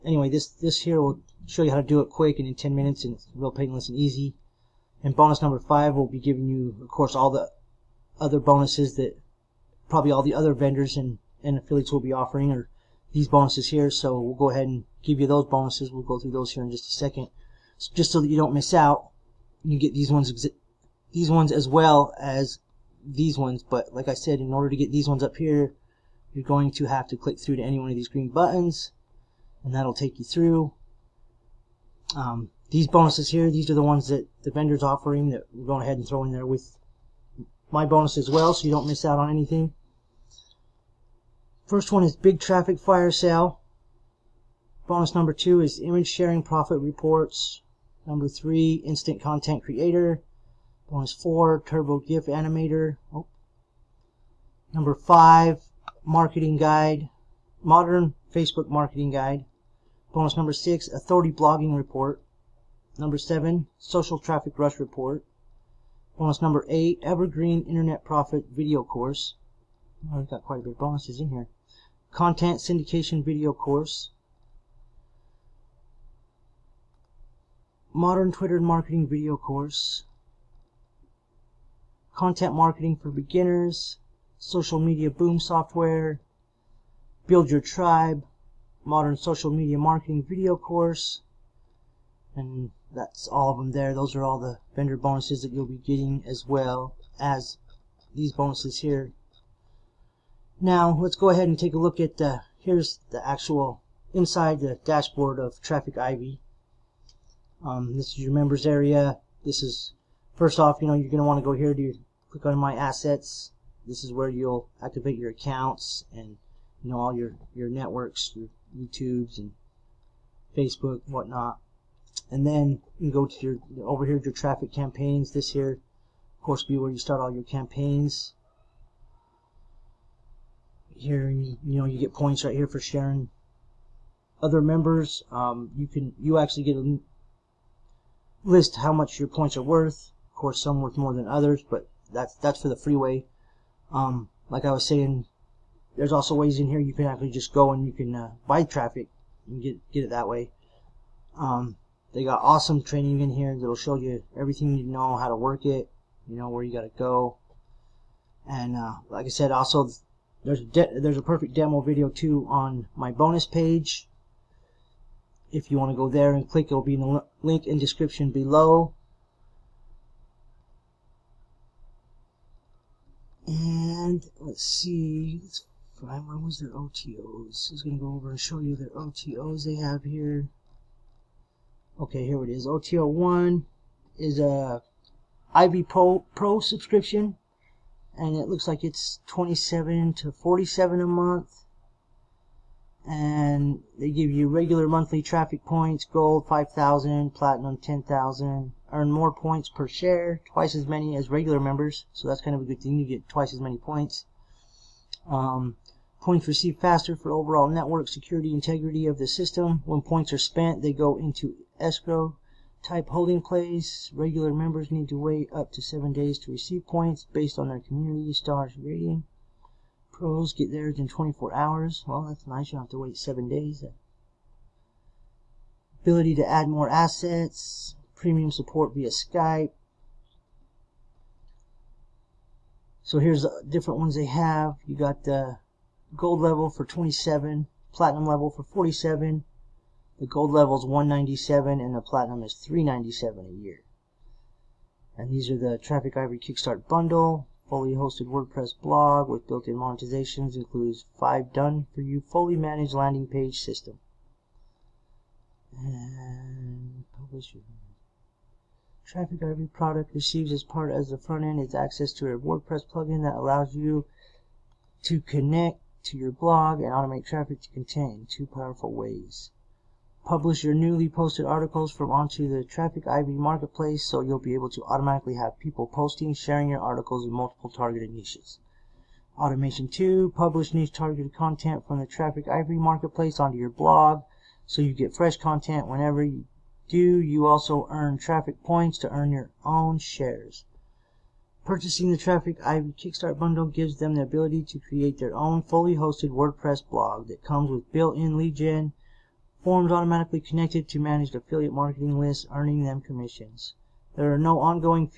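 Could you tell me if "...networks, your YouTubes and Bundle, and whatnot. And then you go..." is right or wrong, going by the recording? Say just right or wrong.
wrong.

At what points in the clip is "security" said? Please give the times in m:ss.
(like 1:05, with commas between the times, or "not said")
3:28.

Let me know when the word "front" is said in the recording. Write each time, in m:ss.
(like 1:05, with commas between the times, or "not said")
4:21.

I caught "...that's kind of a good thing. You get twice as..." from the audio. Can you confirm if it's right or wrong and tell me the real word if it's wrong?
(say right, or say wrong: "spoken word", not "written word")
right.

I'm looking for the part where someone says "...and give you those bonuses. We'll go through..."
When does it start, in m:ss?
0:14.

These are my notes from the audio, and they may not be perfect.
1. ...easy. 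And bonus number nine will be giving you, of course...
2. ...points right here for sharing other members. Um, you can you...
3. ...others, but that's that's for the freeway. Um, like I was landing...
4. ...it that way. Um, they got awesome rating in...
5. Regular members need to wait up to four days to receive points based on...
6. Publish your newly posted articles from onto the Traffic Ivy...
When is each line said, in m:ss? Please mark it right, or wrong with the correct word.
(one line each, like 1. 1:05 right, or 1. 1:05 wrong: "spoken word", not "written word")
1. 0:03 wrong: "five", not "nine"
2. 2:12 right
3. 2:21 wrong: "saying", not "landing"
4. 2:30 wrong: "training", not "rating"
5. 3:34 wrong: "seven", not "four"
6. 4:30 right.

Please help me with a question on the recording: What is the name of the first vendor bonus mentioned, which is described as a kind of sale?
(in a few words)
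Big Traffic Fire Sale.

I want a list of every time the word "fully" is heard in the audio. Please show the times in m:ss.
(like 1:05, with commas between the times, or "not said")
4:07, 4:12, 4:55.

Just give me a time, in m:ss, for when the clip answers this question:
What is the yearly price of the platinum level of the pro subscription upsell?
4:02.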